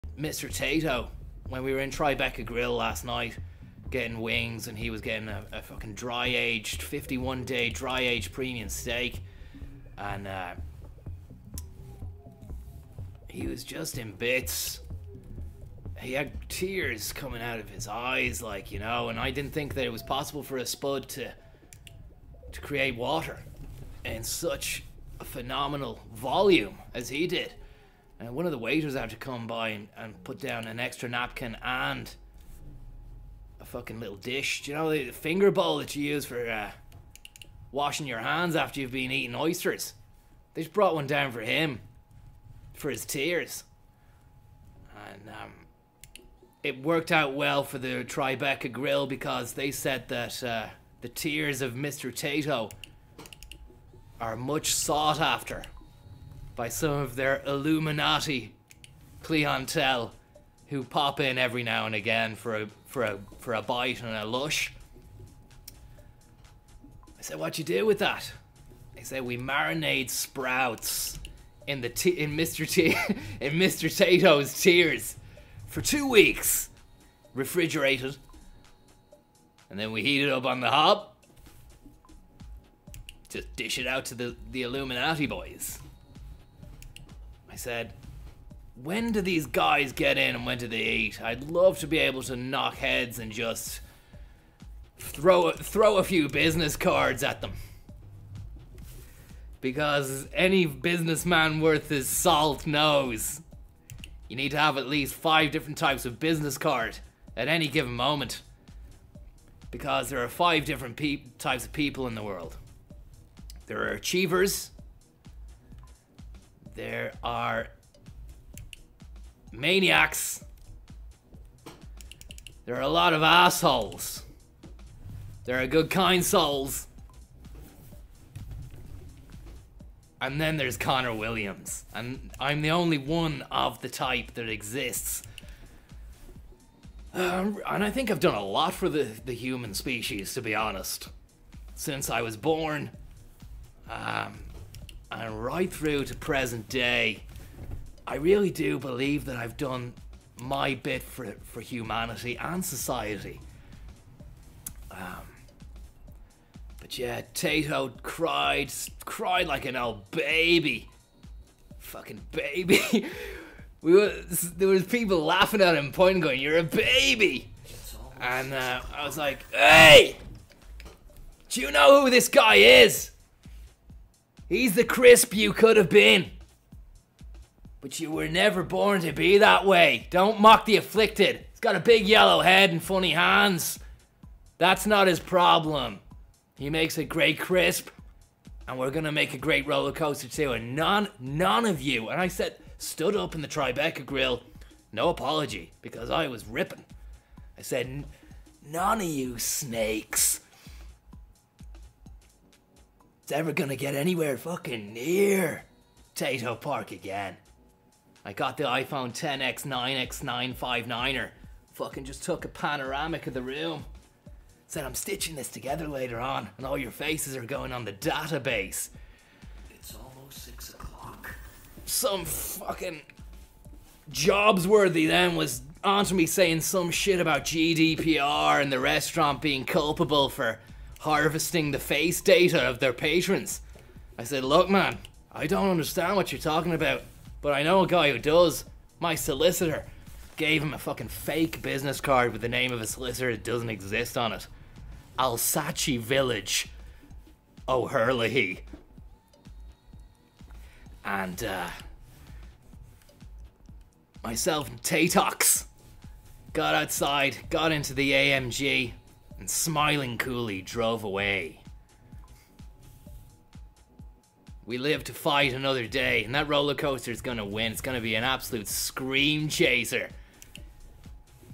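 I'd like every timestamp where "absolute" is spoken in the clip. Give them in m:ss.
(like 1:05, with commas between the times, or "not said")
4:28.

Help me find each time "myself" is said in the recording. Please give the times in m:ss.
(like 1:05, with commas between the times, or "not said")
4:14.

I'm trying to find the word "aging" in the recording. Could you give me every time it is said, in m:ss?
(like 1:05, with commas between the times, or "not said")
not said.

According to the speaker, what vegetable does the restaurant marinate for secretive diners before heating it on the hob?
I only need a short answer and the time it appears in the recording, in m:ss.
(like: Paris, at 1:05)
Sprouts, at 1:10.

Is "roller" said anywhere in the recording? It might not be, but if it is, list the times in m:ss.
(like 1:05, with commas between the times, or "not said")
3:09, 4:26.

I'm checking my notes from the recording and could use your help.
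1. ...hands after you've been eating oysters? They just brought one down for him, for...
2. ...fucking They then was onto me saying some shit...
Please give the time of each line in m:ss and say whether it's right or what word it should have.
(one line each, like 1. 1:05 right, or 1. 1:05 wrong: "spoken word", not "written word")
1. 0:38 right
2. 3:42 wrong: "Jobsworthy", not "They".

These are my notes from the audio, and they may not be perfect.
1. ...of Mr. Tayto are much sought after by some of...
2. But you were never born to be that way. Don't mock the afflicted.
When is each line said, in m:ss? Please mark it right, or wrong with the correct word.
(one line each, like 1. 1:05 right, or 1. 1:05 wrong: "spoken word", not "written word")
1. 0:51 right
2. 2:57 right.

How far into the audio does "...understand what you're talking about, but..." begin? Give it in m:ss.
3:55.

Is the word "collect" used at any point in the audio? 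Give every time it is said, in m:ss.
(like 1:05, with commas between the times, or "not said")
not said.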